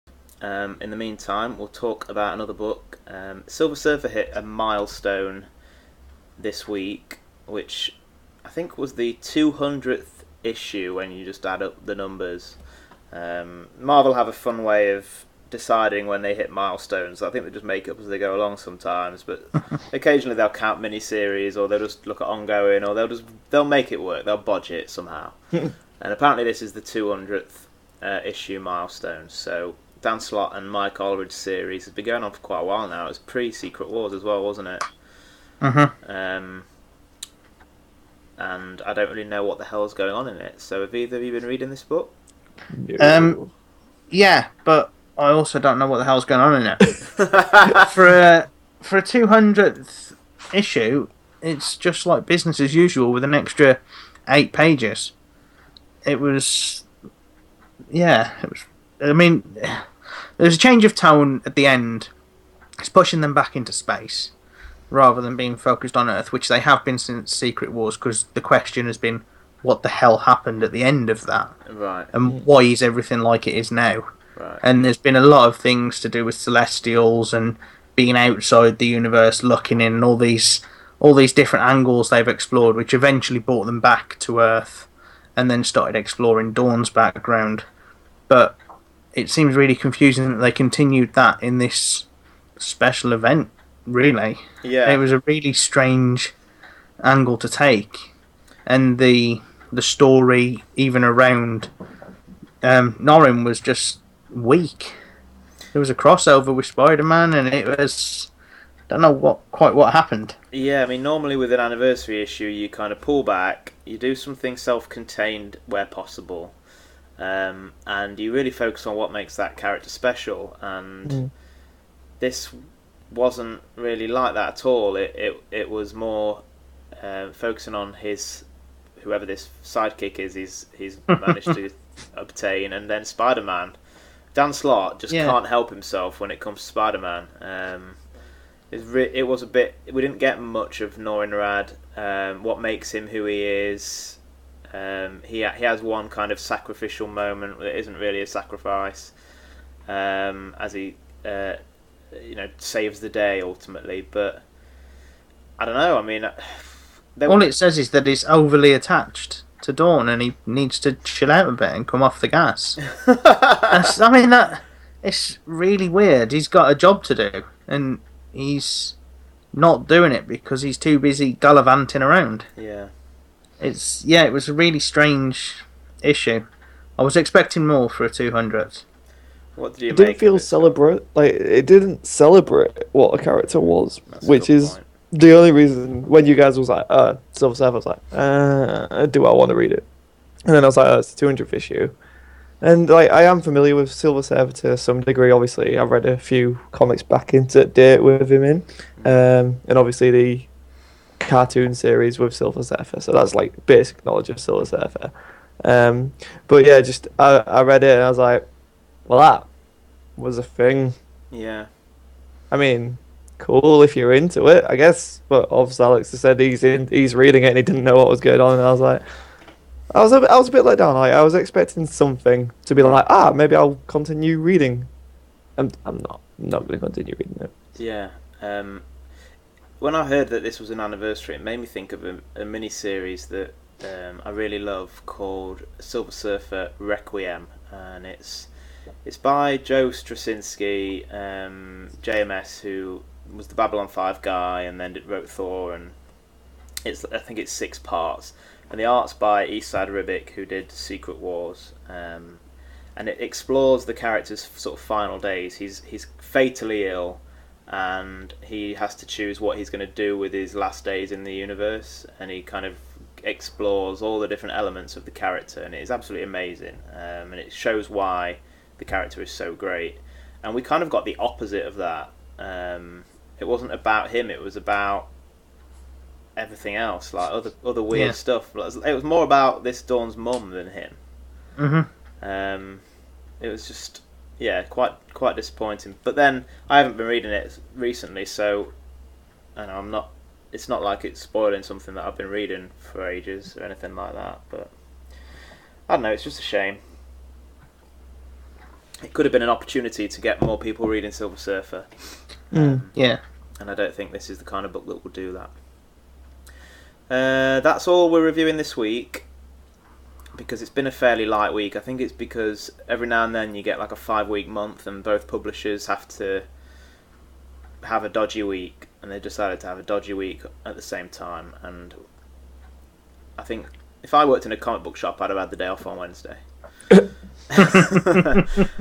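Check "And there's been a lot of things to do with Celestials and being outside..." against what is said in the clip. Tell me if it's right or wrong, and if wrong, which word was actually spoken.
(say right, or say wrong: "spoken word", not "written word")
right.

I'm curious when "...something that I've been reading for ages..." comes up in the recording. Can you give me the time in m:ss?
4:51.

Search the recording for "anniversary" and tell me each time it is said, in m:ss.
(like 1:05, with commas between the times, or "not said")
1:51, 3:50.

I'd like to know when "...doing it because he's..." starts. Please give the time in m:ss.
2:49.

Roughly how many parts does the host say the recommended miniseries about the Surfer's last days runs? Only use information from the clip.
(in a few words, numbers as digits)
6.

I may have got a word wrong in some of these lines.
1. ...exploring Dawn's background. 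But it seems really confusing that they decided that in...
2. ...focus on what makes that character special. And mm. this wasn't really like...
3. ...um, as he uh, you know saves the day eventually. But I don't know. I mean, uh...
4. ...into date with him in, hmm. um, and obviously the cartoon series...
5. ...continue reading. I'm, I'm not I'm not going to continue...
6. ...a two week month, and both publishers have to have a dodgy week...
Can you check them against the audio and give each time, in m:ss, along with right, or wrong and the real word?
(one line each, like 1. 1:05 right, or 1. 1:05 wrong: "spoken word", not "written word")
1. 1:25 wrong: "continued", not "decided"
2. 1:58 right
3. 2:29 wrong: "ultimately", not "eventually"
4. 3:17 right
5. 3:43 right
6. 5:13 wrong: "five", not "two".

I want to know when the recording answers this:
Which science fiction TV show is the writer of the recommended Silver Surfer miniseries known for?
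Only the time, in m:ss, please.
4:03.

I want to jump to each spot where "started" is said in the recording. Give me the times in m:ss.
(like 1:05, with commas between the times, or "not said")
1:25.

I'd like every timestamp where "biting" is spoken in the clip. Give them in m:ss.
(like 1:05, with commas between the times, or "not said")
not said.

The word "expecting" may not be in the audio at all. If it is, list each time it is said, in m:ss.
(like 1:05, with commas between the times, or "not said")
2:57, 3:41.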